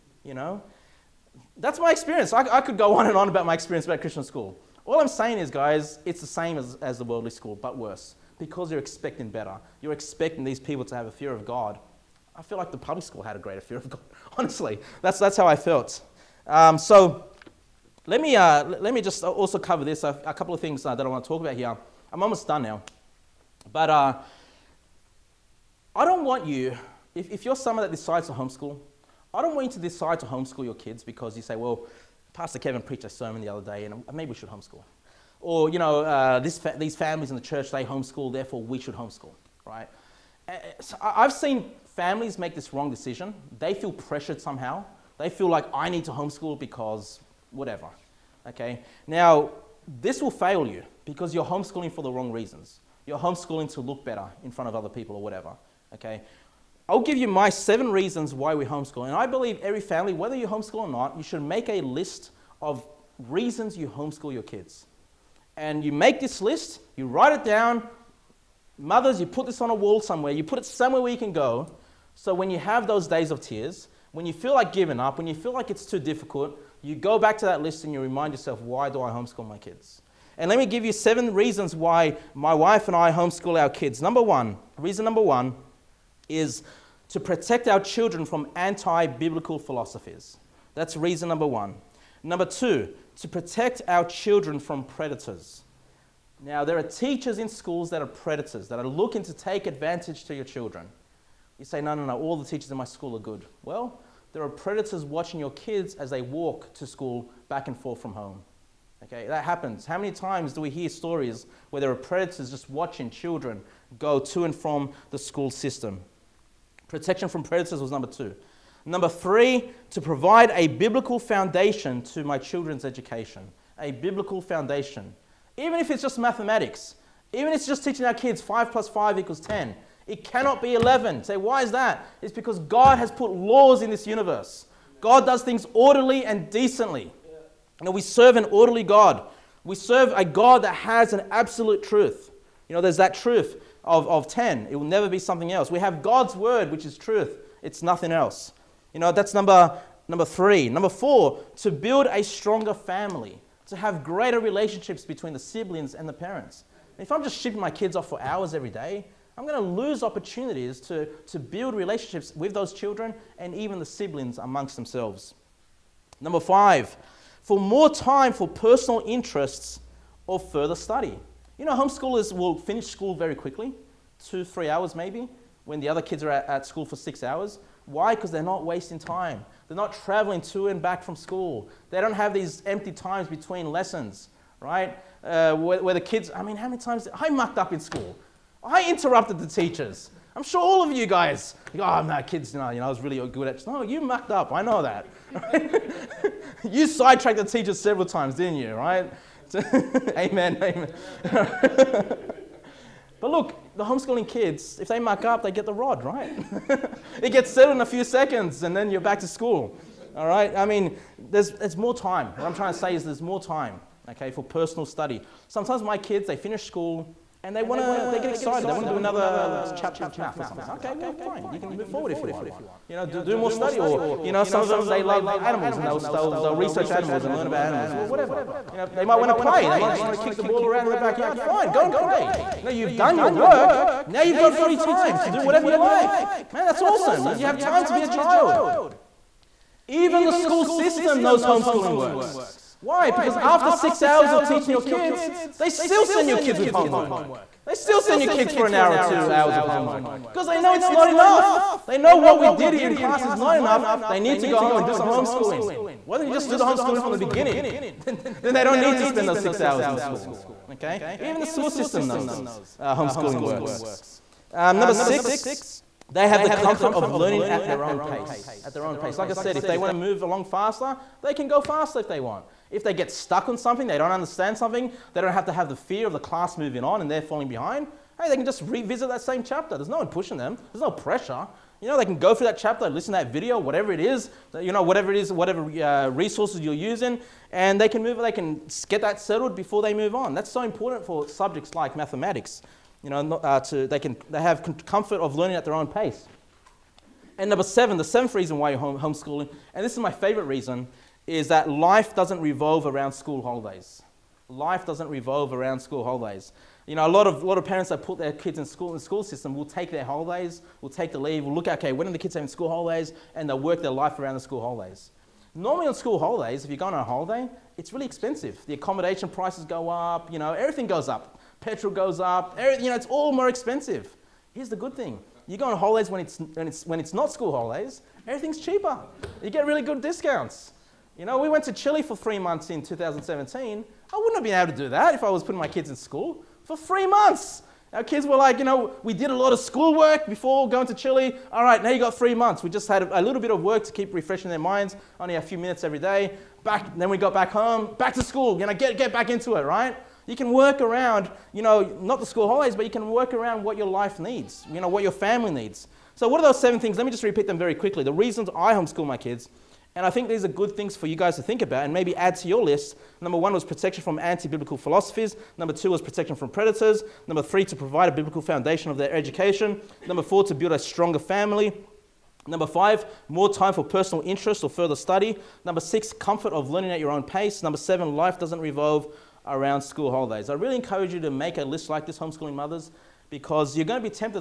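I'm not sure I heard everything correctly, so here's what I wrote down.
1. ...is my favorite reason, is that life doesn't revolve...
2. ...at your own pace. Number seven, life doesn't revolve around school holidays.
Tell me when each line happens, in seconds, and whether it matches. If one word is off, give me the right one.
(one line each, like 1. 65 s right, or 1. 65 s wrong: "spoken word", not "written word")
1. 299 s right
2. 376 s right.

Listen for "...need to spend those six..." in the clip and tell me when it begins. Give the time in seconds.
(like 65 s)
258 s.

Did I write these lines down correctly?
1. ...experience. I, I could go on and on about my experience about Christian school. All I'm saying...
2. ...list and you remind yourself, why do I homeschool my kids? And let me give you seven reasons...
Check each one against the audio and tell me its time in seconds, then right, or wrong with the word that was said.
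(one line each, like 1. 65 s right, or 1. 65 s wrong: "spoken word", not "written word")
1. 1 s right
2. 77 s right.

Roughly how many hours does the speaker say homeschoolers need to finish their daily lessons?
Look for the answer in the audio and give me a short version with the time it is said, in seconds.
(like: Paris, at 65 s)
2 to 3 hours, at 174 s.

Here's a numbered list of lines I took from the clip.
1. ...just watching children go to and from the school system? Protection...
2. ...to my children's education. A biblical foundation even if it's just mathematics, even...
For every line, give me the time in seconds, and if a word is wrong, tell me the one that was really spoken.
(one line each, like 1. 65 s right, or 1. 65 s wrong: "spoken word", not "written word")
1. 112 s right
2. 122 s right.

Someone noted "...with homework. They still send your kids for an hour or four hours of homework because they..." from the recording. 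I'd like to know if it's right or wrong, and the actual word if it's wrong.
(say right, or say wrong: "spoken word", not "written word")
wrong: "two", not "four".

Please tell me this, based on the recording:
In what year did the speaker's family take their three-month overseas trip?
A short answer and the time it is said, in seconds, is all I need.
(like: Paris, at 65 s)
2017, at 332 s.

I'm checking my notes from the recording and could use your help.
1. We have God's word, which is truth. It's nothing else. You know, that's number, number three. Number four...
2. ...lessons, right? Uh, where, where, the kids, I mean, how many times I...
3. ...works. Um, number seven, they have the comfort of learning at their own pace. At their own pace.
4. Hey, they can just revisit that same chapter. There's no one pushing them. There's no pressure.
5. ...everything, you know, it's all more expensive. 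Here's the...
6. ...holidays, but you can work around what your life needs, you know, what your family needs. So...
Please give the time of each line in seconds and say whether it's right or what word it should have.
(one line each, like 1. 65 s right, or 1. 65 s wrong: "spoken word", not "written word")
1. 145 s right
2. 183 s right
3. 263 s wrong: "six", not "seven"
4. 278 s right
5. 322 s right
6. 352 s right.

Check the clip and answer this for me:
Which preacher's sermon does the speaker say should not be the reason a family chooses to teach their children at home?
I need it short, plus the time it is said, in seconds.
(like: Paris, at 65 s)
Pastor Kevin, at 32 s.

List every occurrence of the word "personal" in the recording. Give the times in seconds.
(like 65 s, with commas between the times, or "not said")
168 s, 214 s, 373 s.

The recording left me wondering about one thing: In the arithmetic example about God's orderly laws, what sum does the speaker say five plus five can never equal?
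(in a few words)
11.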